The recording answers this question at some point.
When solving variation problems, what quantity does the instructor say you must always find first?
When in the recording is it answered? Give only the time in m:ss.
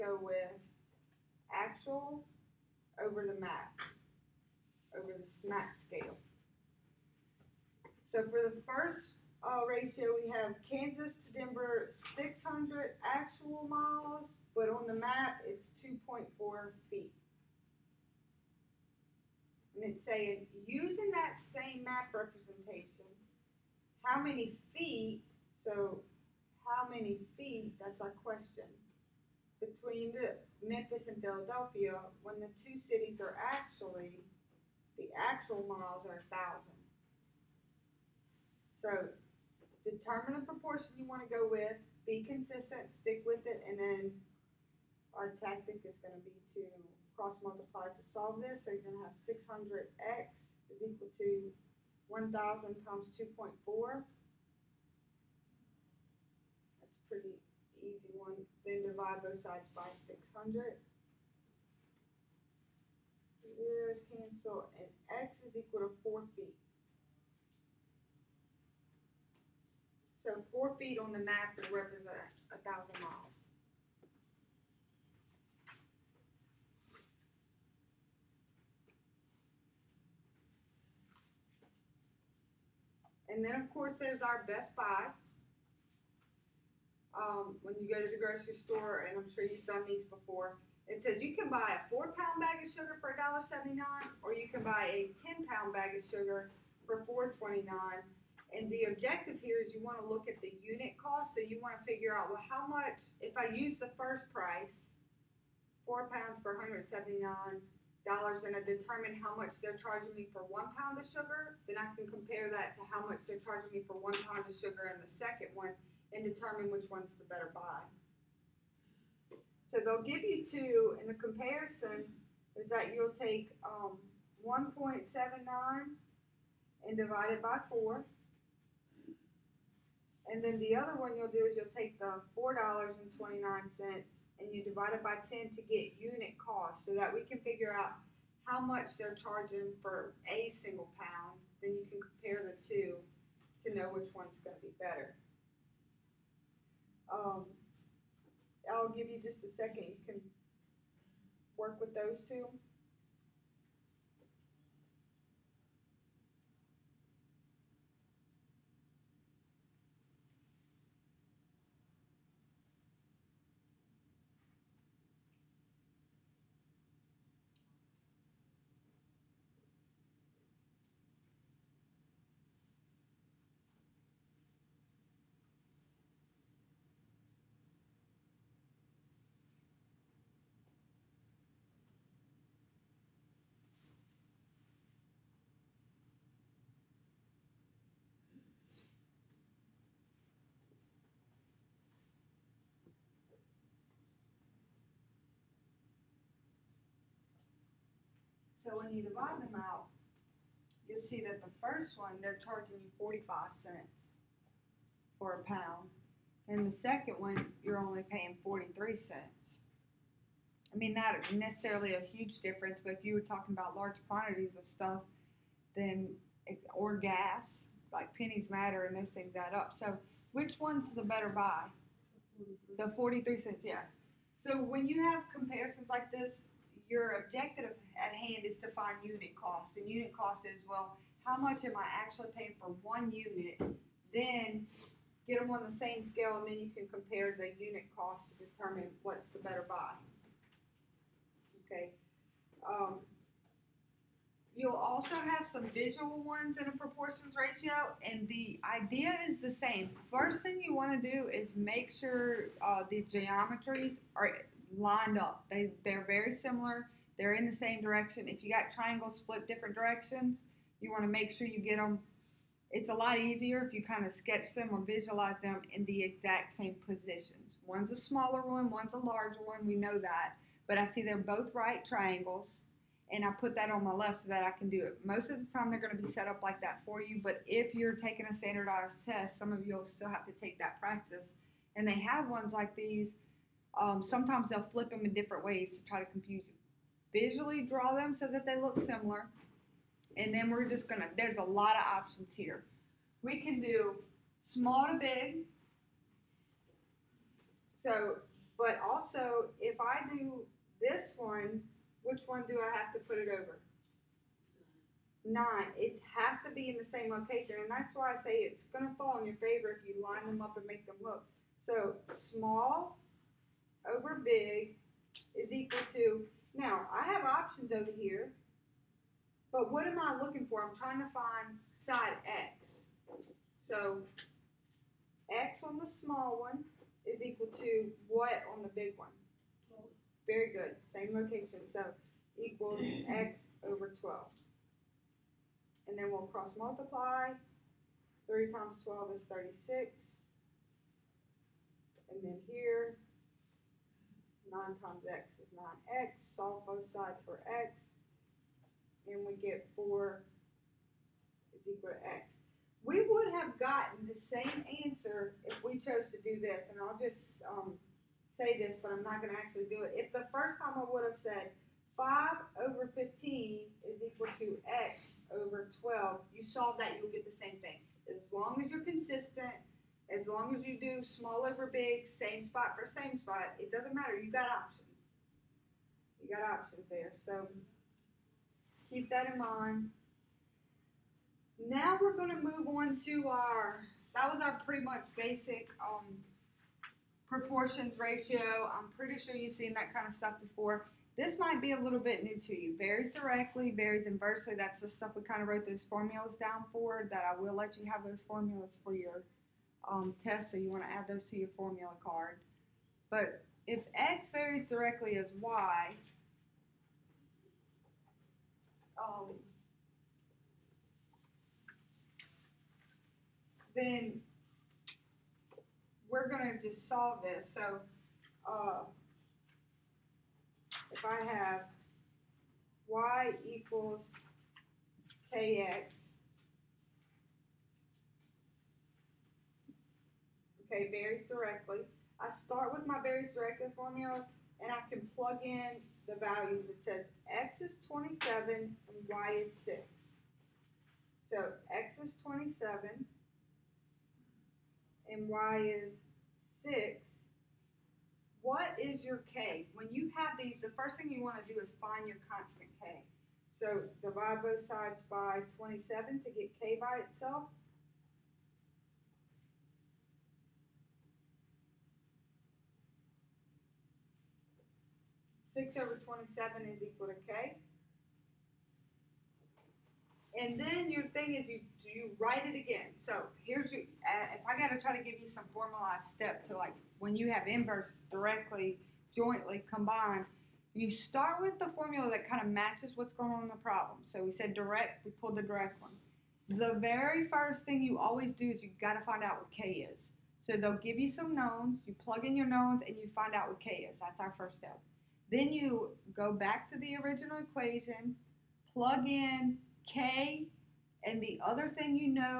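7:32.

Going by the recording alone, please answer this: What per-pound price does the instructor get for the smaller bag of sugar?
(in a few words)
45 cents.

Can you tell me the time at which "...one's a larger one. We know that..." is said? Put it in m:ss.
4:28.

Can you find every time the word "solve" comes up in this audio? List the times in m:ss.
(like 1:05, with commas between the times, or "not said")
0:48, 5:46, 6:06, 6:56.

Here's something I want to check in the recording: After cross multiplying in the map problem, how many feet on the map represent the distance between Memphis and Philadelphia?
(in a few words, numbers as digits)
4 feet.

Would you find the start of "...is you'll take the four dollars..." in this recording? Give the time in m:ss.
2:11.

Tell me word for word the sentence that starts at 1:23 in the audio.
And then, of course, there's our Best Buy.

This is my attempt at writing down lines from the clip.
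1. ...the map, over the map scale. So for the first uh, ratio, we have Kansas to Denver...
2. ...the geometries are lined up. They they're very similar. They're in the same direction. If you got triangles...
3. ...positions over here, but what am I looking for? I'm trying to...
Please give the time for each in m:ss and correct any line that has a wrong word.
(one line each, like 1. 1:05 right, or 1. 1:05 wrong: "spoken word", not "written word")
1. 0:03 right
2. 4:12 right
3. 5:17 wrong: "options", not "positions".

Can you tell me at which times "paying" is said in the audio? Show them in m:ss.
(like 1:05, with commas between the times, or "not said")
3:28, 3:52.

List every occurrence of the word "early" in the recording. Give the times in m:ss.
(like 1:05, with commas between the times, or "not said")
not said.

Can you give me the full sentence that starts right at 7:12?
I start with my varies directly formula and I can plug in the values.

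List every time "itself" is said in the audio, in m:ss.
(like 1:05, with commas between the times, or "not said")
7:37.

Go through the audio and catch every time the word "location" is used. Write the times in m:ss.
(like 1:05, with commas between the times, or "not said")
5:07, 5:31.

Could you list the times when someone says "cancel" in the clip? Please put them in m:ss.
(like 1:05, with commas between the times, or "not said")
1:04.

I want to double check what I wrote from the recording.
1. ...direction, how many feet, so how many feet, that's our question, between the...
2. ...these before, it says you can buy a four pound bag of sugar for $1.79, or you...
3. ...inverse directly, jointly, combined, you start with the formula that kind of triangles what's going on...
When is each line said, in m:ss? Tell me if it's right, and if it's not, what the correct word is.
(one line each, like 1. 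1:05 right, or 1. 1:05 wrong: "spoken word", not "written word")
1. 0:22 wrong: "representation", not "direction"
2. 1:29 right
3. 7:57 wrong: "matches", not "triangles".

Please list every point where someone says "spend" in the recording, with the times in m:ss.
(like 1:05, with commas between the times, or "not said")
not said.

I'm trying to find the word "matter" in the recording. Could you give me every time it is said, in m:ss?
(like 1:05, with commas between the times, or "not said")
3:38, 6:13.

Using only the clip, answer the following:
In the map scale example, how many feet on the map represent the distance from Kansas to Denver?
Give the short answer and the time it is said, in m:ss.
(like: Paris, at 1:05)
2.4 feet, at 0:15.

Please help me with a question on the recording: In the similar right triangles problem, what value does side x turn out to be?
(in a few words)
4.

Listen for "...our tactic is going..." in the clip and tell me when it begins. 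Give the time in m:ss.
0:45.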